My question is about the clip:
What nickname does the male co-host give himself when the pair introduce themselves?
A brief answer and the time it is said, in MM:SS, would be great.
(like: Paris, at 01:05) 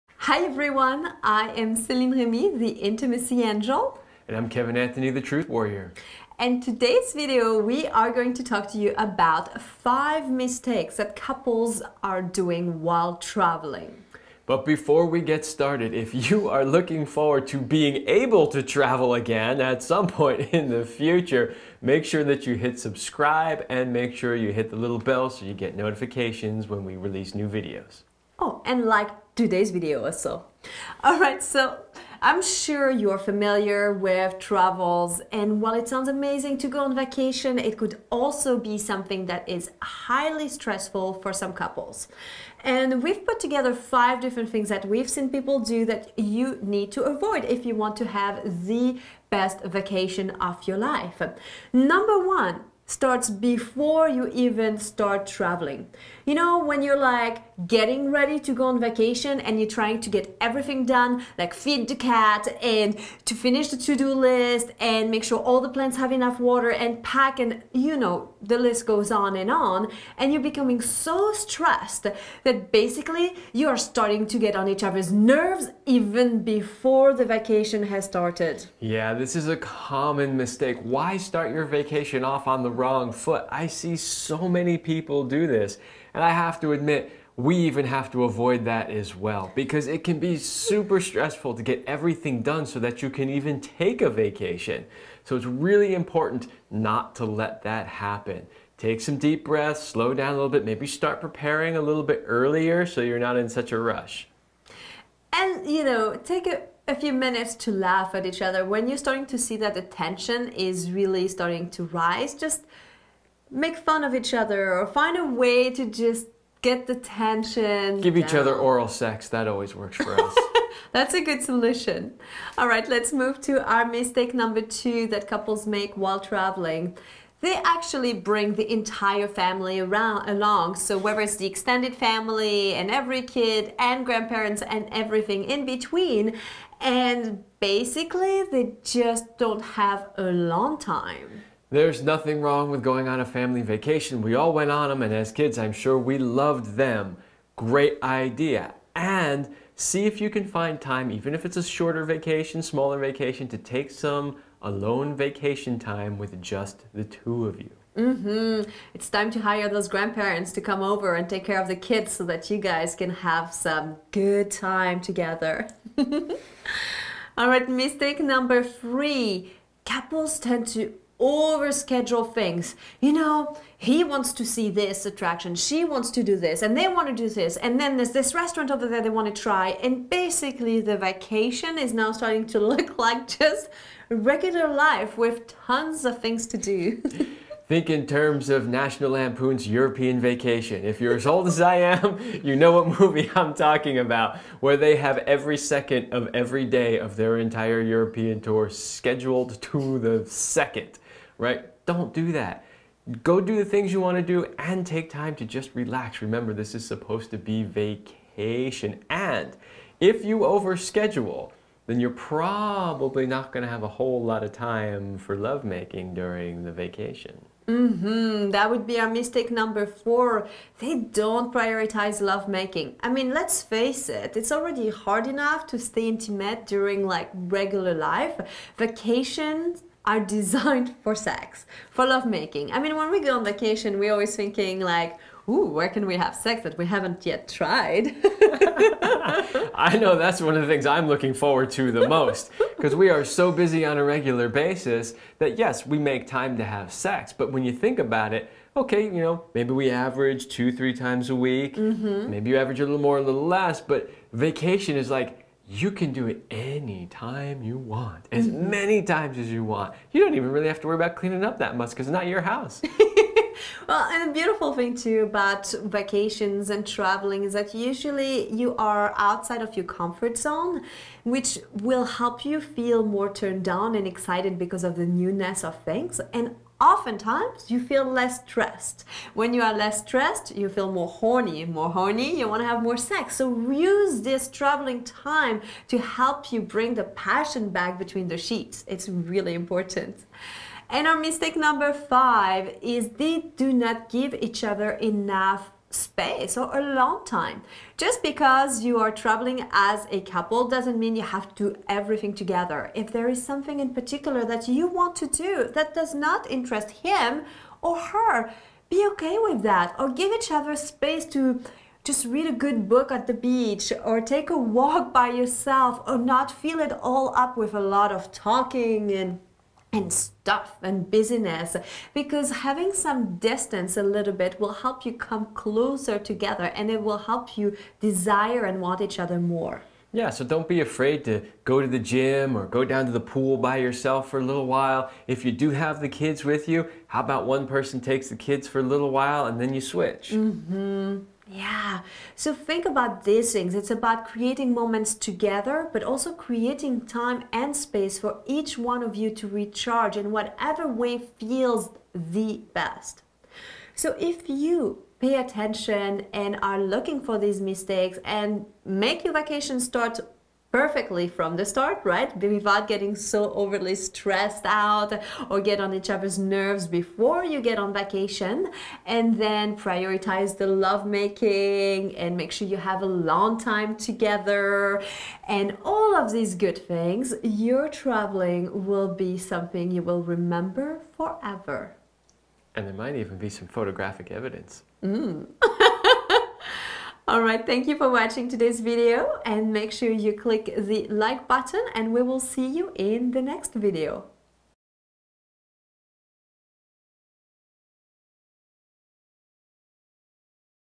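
Truth Warrior, at 00:05.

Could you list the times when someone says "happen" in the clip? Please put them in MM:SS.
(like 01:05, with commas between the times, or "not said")
01:37.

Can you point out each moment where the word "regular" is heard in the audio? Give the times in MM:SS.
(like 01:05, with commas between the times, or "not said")
03:04, 03:47, 04:04.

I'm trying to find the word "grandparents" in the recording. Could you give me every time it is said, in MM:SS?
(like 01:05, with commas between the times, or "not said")
02:14, 02:39.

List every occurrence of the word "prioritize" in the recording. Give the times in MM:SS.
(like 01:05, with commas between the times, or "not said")
03:41, 06:09.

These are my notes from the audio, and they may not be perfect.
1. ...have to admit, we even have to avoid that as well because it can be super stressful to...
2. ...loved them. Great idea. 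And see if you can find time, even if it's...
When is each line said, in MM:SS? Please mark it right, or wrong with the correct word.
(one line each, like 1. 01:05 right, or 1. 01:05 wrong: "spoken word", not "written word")
1. 01:26 right
2. 02:26 right.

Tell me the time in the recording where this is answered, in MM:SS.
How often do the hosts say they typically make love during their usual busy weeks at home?
04:10.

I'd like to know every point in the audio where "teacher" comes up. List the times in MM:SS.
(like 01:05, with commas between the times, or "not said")
not said.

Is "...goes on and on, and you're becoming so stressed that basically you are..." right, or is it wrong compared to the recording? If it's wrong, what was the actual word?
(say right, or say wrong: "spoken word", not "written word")
right.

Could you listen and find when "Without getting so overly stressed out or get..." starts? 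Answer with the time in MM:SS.
06:02.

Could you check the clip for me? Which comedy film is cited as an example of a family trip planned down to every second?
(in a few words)
National Lampoon's European Vacation.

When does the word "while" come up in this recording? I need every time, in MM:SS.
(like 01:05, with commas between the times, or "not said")
00:12, 00:35, 02:05, 05:34, 05:39.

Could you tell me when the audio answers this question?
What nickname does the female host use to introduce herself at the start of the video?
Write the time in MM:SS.
00:02.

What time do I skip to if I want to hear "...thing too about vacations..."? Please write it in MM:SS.
04:24.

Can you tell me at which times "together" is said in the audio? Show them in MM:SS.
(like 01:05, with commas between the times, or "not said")
00:43, 02:45, 05:02, 05:26, 05:45, 06:13.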